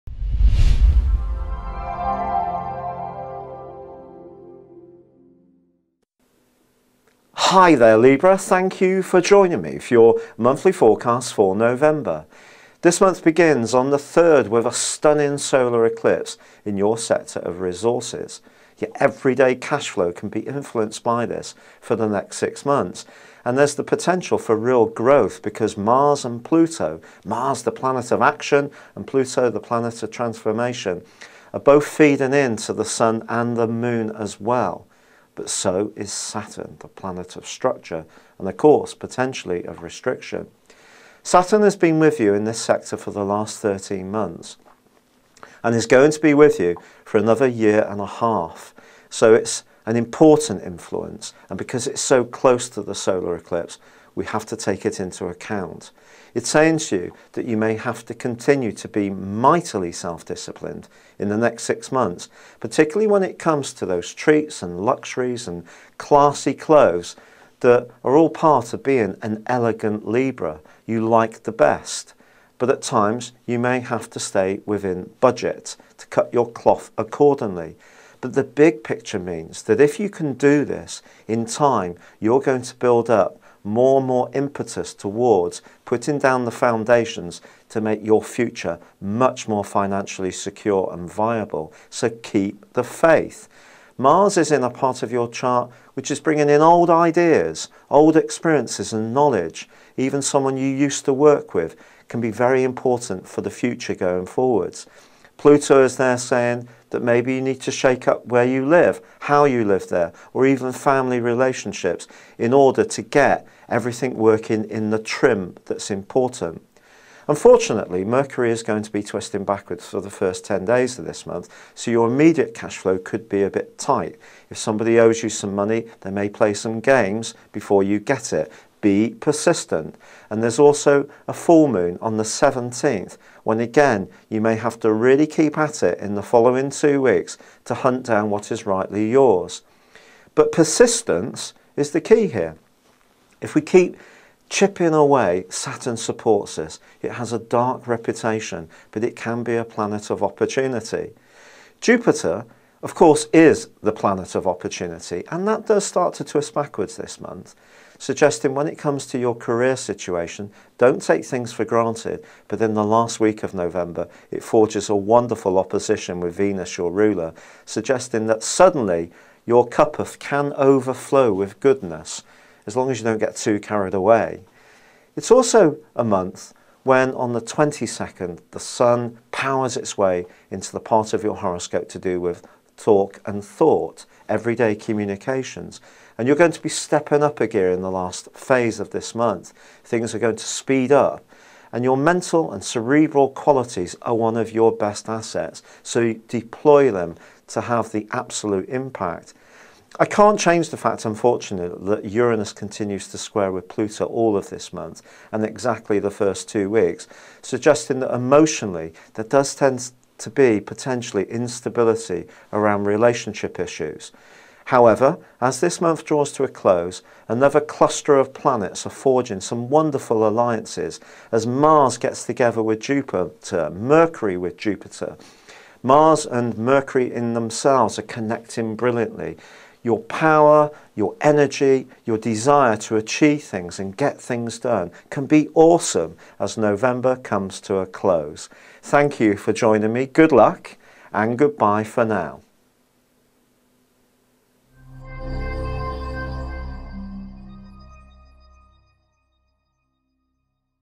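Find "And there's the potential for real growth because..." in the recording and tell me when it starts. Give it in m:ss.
0:23.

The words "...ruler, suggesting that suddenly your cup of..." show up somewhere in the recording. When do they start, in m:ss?
2:46.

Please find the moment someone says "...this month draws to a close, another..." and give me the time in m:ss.
3:35.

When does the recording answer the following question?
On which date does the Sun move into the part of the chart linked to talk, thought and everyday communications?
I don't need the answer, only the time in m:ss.
2:57.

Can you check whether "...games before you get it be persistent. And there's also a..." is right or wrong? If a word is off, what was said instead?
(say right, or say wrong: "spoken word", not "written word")
right.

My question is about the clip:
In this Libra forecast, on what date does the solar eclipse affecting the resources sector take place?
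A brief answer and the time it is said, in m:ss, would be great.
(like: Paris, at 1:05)
November 3, at 0:13.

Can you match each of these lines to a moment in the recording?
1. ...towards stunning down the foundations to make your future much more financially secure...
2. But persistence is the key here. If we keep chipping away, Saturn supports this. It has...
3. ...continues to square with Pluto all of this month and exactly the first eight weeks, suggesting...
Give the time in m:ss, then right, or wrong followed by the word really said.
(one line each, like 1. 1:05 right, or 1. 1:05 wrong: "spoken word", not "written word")
1. 1:24 wrong: "putting", not "stunning"
2. 2:20 right
3. 3:22 wrong: "two", not "eight".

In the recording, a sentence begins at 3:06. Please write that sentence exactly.
And you're going to be stepping up a gear in the last phase of this month.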